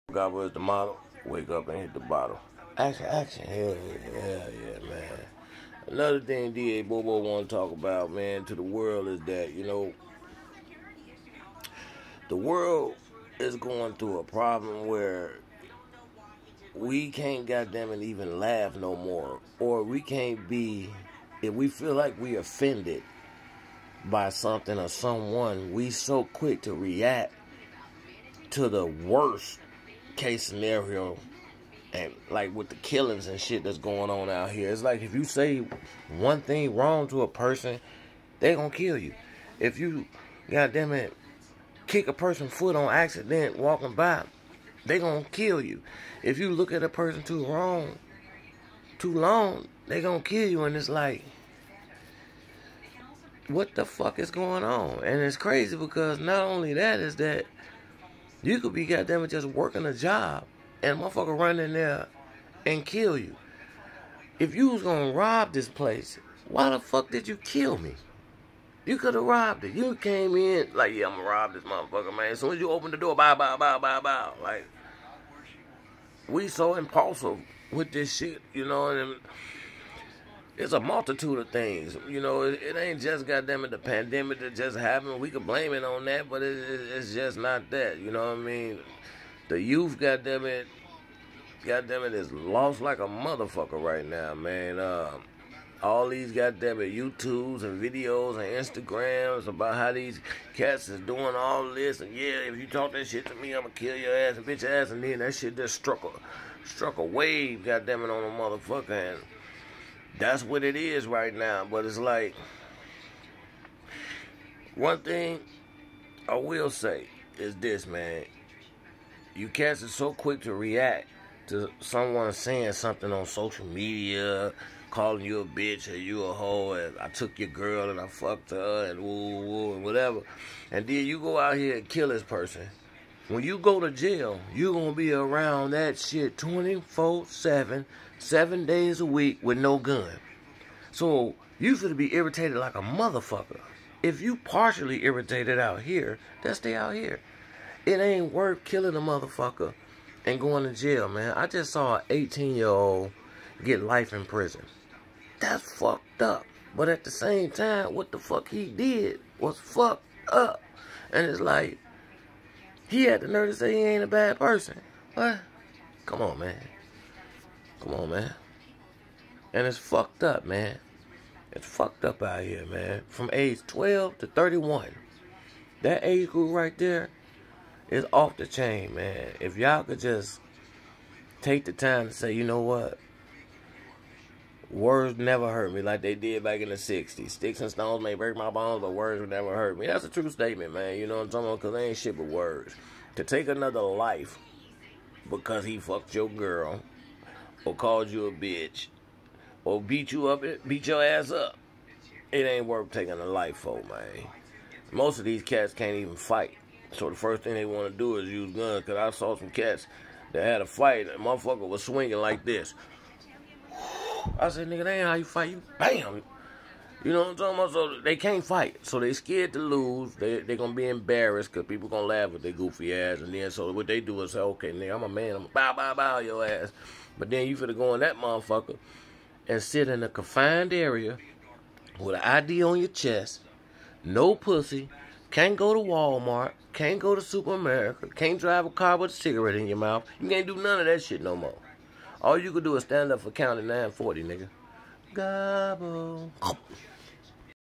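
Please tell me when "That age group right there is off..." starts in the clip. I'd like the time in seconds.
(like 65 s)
175 s.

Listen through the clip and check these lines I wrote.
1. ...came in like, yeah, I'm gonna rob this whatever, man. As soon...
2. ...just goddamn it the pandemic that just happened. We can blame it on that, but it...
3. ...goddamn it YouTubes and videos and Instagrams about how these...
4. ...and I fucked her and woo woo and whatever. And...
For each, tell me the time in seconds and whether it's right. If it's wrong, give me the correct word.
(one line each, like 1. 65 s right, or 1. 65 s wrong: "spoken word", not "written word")
1. 69 s wrong: "motherfucker", not "whatever"
2. 83 s right
3. 96 s right
4. 127 s right.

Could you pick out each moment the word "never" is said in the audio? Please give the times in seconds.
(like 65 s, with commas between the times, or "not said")
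185 s, 189 s.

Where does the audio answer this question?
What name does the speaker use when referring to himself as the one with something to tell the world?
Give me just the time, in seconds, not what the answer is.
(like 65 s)
6 s.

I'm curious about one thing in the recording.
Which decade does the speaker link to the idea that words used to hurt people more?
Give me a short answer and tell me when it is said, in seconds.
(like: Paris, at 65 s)
The 60s, at 186 s.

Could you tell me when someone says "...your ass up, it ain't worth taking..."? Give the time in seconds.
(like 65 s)
200 s.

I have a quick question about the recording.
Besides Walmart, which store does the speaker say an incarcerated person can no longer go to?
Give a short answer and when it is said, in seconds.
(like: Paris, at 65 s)
Super America, at 237 s.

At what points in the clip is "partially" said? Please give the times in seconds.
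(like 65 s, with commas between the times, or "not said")
144 s.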